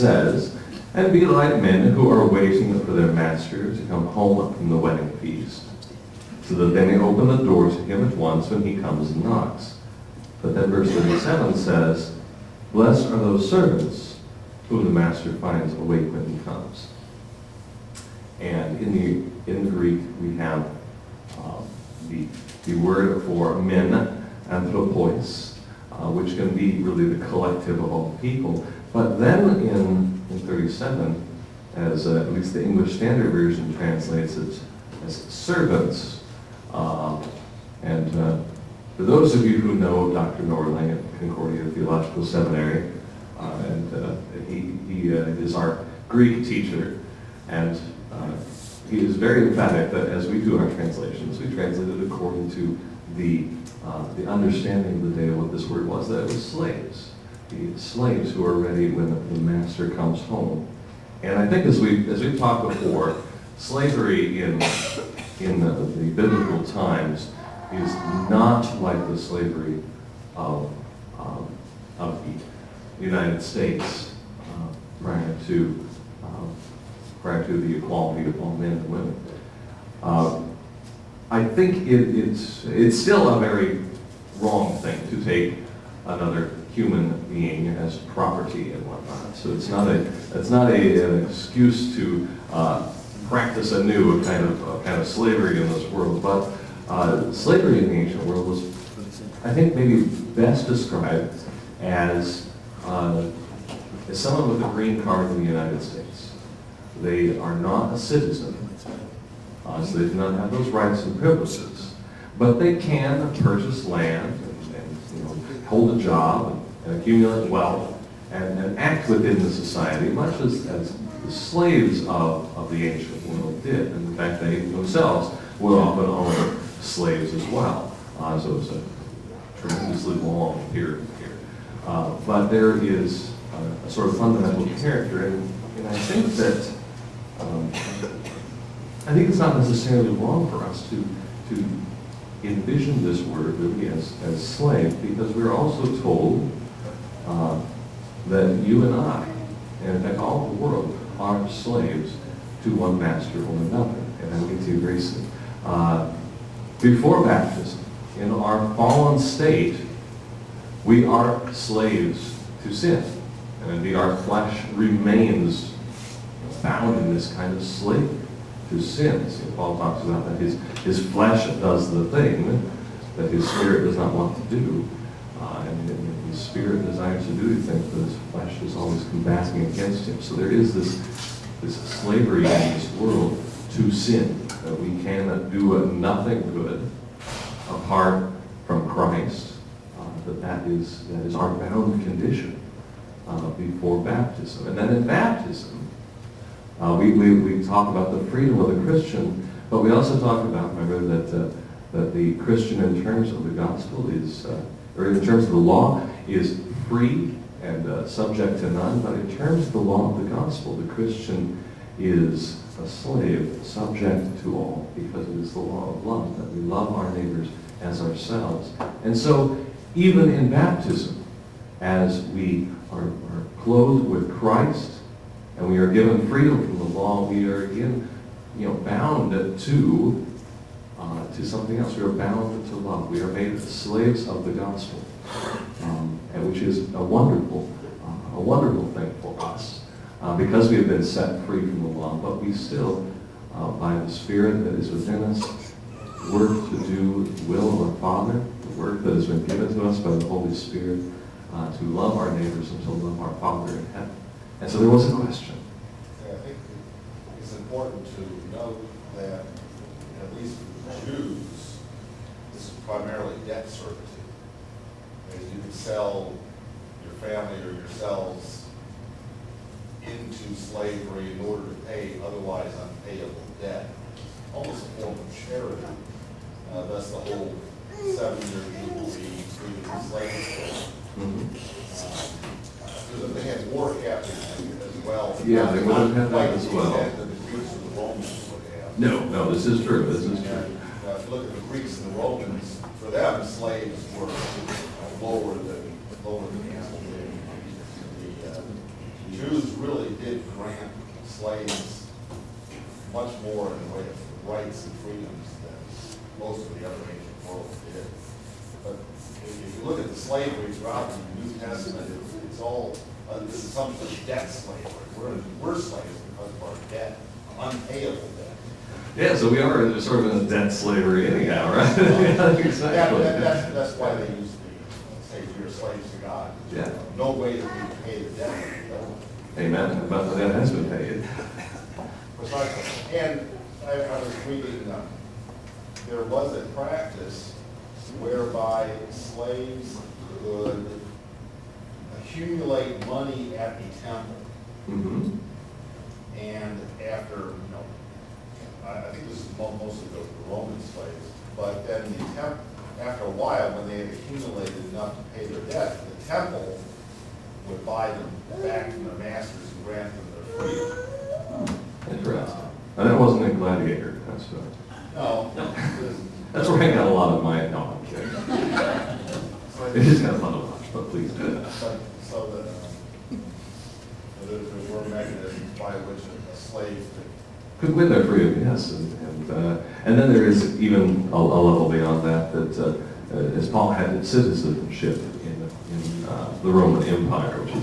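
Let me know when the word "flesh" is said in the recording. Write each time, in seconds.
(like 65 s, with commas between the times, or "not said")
164 s, 171 s, 178 s.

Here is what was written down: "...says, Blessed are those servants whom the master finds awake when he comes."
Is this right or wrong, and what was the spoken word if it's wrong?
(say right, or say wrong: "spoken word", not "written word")
right.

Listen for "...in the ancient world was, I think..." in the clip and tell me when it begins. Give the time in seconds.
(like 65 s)
97 s.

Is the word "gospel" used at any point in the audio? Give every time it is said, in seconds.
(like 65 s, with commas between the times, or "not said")
203 s, 210 s, 234 s.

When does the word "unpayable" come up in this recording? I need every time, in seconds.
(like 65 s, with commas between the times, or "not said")
272 s, 317 s.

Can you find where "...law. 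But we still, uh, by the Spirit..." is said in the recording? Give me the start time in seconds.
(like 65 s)
241 s.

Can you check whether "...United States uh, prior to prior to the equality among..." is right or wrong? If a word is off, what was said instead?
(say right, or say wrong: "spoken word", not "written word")
right.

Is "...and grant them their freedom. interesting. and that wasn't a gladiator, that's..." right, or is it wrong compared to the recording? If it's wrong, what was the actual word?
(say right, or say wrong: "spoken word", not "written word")
right.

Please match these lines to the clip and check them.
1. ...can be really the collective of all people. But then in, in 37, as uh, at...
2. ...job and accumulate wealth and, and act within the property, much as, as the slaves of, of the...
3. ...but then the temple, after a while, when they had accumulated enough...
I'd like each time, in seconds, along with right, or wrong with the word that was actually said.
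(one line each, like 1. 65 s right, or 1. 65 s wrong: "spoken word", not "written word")
1. 26 s right
2. 116 s wrong: "society", not "property"
3. 351 s right.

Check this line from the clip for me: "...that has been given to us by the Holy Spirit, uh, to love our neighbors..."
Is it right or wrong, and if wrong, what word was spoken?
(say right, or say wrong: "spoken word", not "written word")
right.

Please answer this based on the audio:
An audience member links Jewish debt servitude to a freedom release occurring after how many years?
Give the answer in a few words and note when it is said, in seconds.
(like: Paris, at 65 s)
7, at 277 s.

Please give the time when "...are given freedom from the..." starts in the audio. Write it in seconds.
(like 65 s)
225 s.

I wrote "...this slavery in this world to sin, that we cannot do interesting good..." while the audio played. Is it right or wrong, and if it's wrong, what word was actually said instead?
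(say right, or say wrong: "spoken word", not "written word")
wrong: "nothing", not "interesting".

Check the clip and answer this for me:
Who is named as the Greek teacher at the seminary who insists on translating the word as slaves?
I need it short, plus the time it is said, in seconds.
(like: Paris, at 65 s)
Dr. Nordling, at 40 s.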